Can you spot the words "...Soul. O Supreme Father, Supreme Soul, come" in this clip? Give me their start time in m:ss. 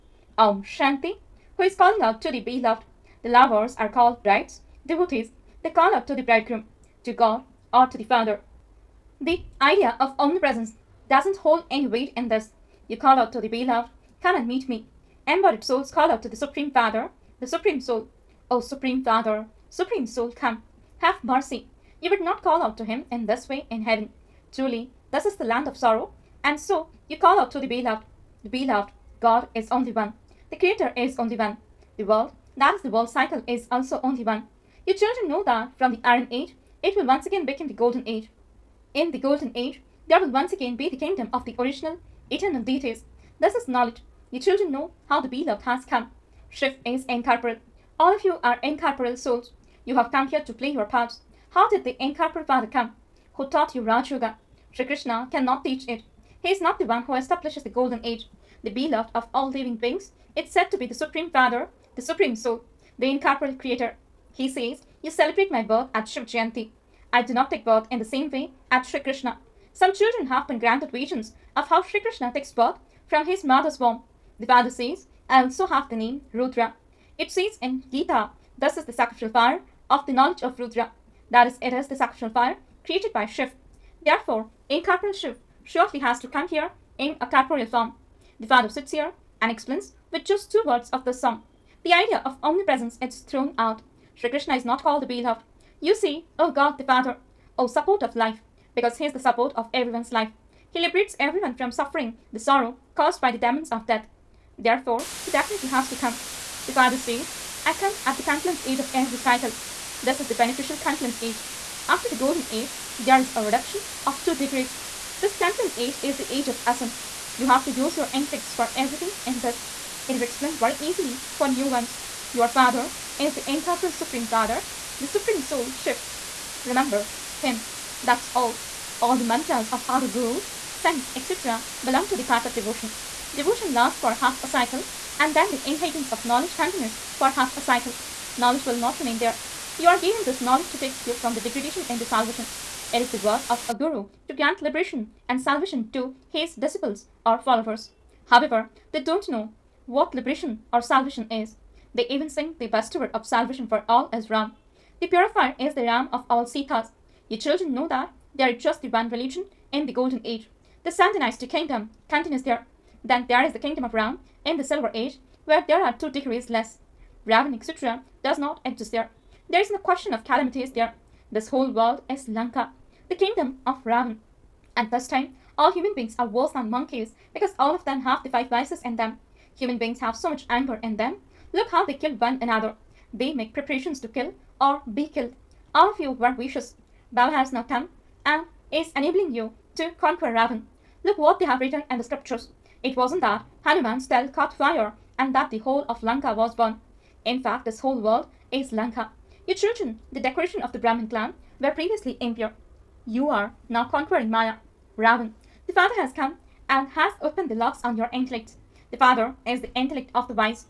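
0:17.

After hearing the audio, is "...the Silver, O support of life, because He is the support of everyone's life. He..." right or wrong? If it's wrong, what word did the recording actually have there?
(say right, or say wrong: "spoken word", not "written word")
wrong: "Father", not "Silver".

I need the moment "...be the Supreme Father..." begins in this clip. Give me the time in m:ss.
1:00.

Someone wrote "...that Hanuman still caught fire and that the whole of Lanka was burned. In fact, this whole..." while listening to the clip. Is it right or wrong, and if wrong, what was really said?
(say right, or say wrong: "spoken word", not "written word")
right.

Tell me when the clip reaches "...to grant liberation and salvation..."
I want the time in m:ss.
2:24.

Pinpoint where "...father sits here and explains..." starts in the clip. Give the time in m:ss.
1:28.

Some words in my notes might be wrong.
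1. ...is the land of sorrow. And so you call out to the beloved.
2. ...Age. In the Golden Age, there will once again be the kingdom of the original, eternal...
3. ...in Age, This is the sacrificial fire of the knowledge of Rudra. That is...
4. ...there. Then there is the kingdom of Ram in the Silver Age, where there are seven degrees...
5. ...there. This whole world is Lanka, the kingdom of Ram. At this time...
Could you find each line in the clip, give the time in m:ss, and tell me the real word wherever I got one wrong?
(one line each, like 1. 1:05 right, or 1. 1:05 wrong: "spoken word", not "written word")
1. 0:25 right
2. 0:38 right
3. 1:17 wrong: "Gita", not "Age"
4. 2:42 wrong: "two", not "seven"
5. 2:50 wrong: "Ravan", not "Ram".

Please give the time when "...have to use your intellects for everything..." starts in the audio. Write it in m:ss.
1:57.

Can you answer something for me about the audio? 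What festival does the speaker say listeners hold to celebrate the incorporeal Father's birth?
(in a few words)
Shiv Jayanti.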